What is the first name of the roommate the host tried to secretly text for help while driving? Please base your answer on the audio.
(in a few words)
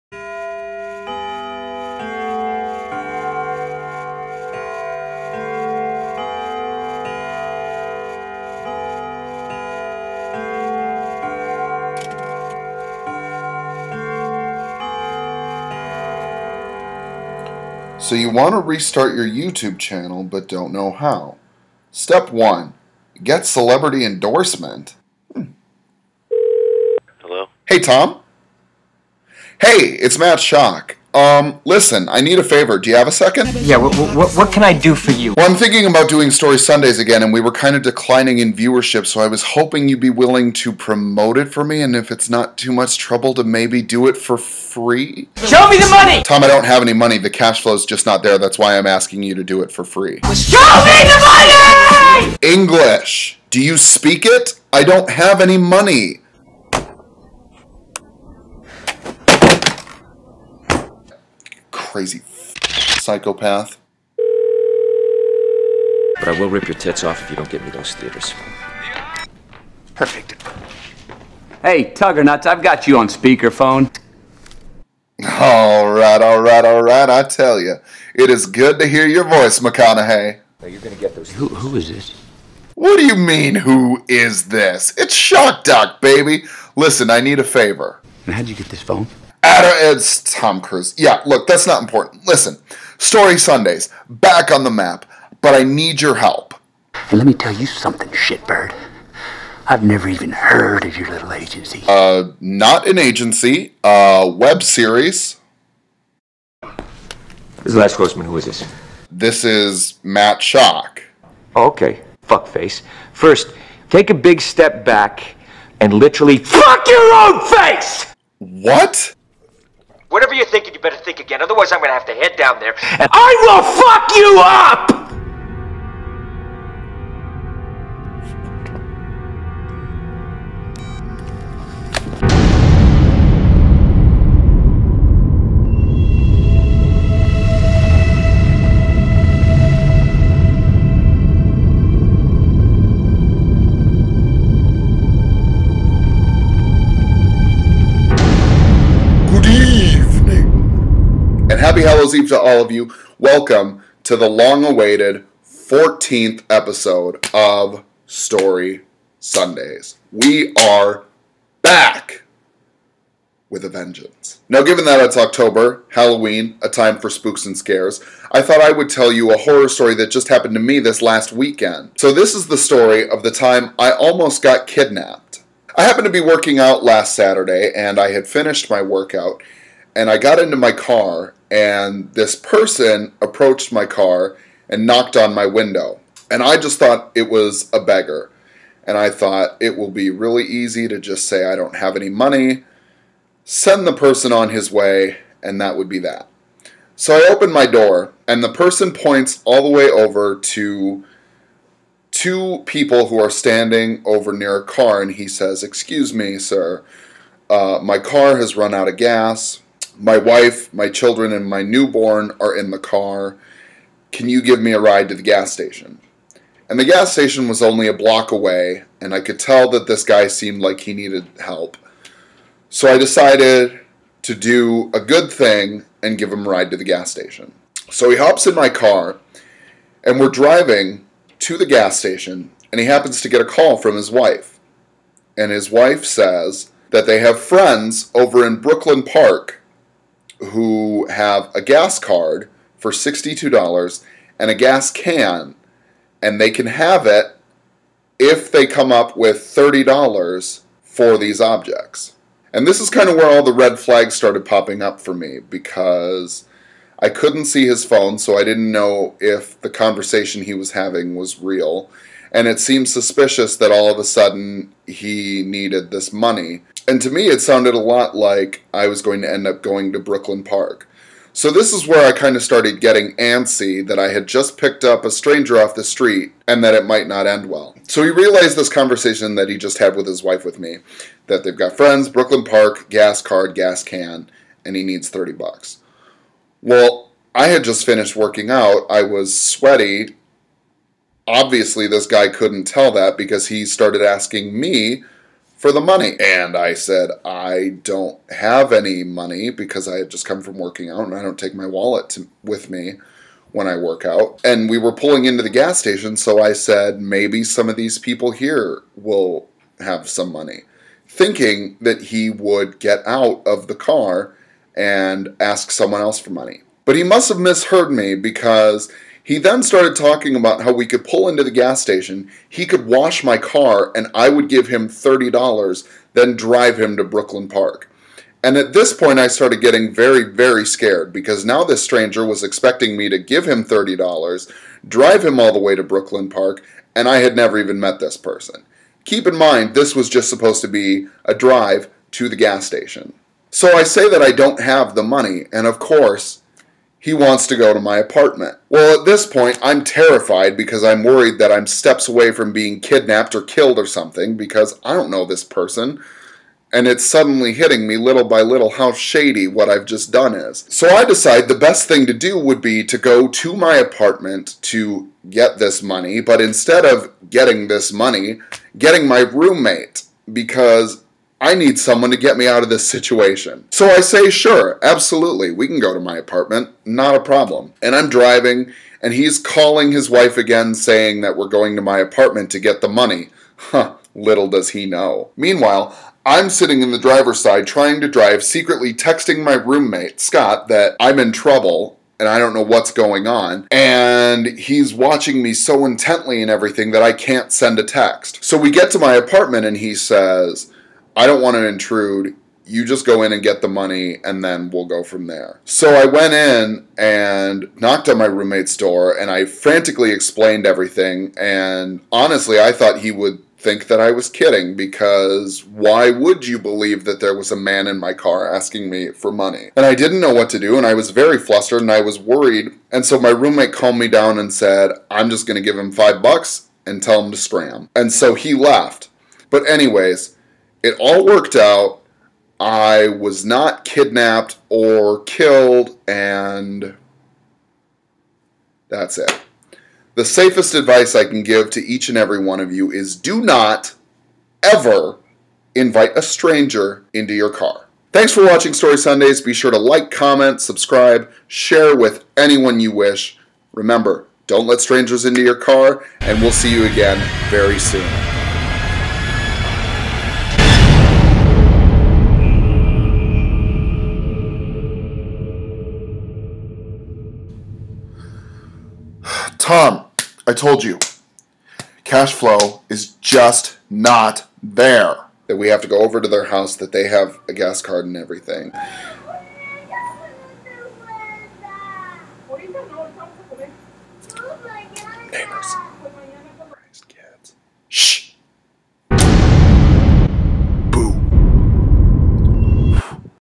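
Scott.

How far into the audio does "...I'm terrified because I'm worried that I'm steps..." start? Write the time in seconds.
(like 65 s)
349 s.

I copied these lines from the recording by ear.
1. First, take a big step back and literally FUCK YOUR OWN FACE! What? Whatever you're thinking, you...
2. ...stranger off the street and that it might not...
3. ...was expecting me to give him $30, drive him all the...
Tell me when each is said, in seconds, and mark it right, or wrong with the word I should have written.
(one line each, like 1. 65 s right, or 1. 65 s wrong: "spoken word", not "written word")
1. 113 s right
2. 275 s right
3. 332 s right.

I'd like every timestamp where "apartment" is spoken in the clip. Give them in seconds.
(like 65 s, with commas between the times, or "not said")
347 s, 363 s, 376 s, 381 s, 399 s.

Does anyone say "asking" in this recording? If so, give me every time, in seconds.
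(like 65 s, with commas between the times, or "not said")
48 s, 294 s, 418 s.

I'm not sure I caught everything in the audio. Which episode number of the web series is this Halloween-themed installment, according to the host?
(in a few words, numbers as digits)
14th.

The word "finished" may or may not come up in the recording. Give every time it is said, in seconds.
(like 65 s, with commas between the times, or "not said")
178 s, 287 s.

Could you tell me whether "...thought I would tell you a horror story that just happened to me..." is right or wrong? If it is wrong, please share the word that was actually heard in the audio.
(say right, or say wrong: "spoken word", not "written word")
right.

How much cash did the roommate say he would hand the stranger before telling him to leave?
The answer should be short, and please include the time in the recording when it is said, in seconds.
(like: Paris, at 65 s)
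5 dollars, at 425 s.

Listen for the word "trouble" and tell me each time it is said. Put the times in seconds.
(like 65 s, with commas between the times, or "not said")
42 s, 391 s.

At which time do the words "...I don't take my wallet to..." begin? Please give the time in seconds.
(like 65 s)
301 s.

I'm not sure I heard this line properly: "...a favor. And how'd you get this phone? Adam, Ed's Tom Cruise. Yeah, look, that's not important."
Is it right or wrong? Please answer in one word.
right.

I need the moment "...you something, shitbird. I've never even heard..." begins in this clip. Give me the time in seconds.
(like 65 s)
97 s.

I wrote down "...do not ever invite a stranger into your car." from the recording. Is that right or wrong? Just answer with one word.
right.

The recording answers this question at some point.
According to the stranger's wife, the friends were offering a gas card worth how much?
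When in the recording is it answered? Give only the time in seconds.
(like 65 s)
242 s.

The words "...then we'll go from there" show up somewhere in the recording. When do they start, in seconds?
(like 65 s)
404 s.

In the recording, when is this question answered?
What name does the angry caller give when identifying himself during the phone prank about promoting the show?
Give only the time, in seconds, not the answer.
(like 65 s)
107 s.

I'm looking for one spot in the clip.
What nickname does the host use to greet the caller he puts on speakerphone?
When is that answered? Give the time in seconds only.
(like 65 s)
71 s.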